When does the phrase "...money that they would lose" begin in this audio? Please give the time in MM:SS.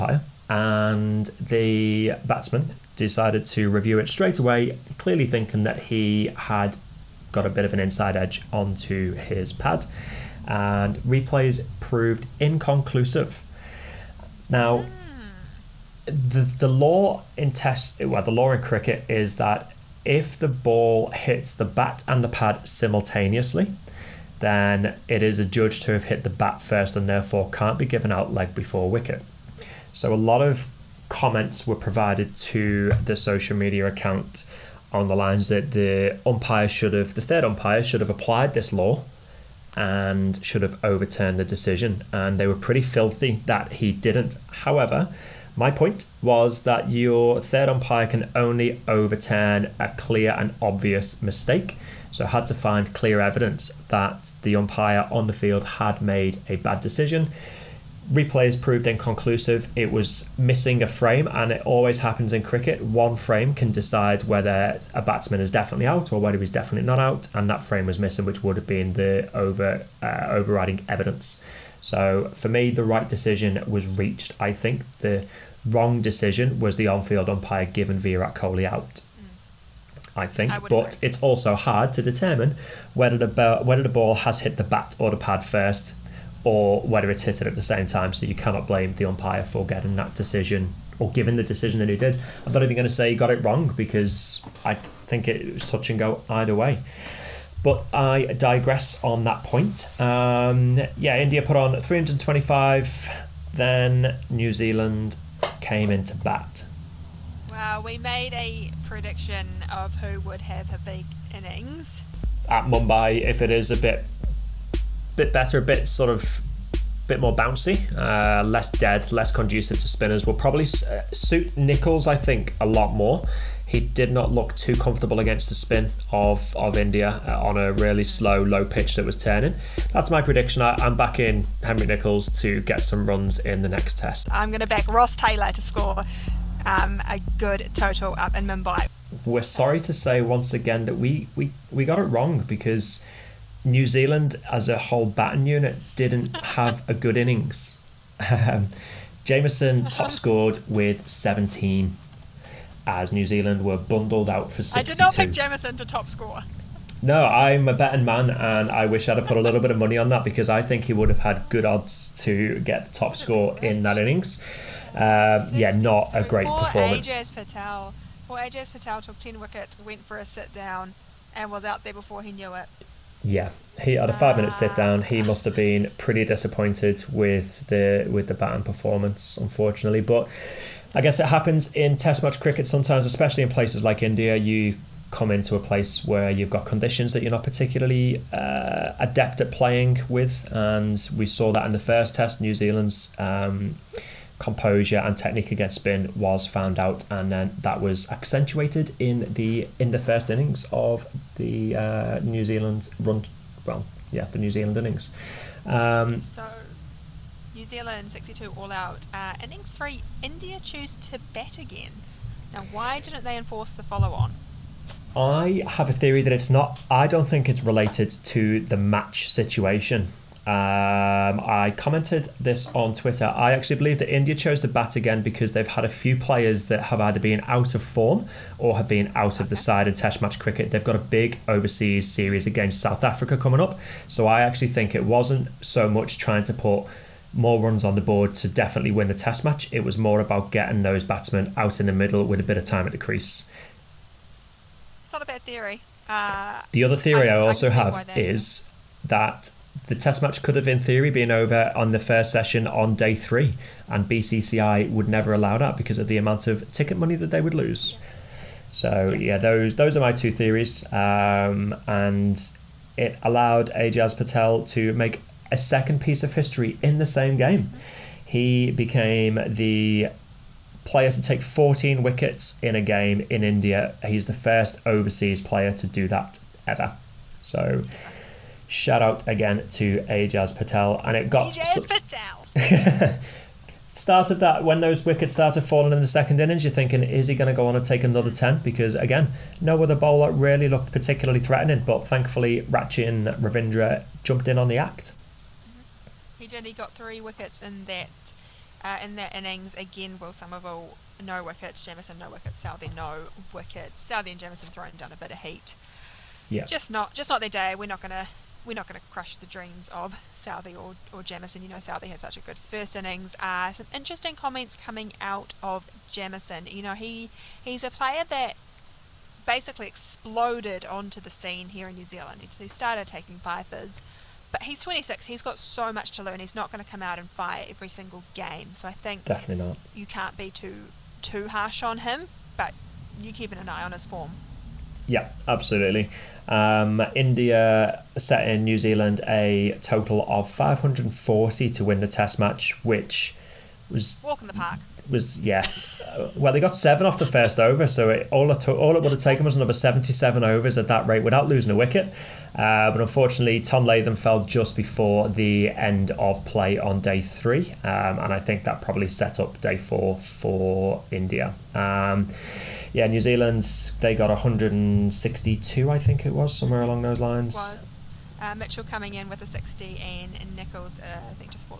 04:16.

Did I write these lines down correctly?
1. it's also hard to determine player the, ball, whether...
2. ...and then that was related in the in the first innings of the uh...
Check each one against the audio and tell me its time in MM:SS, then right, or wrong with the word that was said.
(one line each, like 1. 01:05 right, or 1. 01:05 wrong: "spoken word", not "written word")
1. 01:21 wrong: "whether", not "player"
2. 03:17 wrong: "accentuated", not "related".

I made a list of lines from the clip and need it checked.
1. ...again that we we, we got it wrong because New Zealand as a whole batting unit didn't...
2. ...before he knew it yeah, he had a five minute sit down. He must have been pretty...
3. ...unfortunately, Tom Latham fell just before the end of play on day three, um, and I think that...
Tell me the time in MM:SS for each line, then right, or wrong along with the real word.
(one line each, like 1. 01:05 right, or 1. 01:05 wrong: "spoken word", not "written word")
1. 02:20 right
2. 02:51 right
3. 05:53 right.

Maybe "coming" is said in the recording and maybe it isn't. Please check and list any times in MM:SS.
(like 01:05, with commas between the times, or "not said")
03:53, 05:14, 06:08.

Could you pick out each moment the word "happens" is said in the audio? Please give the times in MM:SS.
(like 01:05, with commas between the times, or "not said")
01:02, 03:01.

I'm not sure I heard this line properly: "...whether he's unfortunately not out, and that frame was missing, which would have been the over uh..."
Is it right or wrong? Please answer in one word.
wrong.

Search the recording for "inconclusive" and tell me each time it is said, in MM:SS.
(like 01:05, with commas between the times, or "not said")
00:12, 00:58.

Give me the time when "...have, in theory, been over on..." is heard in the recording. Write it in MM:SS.
04:10.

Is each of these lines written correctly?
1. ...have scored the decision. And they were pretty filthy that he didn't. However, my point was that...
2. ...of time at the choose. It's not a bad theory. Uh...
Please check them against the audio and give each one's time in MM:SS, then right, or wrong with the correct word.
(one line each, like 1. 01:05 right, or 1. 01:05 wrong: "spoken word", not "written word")
1. 00:40 wrong: "overturned", not "scored"
2. 04:02 wrong: "crease", not "choose".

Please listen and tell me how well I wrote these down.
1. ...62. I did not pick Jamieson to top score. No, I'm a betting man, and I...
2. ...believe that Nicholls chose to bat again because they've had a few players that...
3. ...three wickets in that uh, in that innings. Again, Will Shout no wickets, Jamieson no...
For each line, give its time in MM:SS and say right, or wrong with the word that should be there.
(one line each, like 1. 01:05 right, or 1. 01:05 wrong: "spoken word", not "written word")
1. 02:34 right
2. 03:43 wrong: "India", not "Nicholls"
3. 04:56 wrong: "Somerville", not "Shout".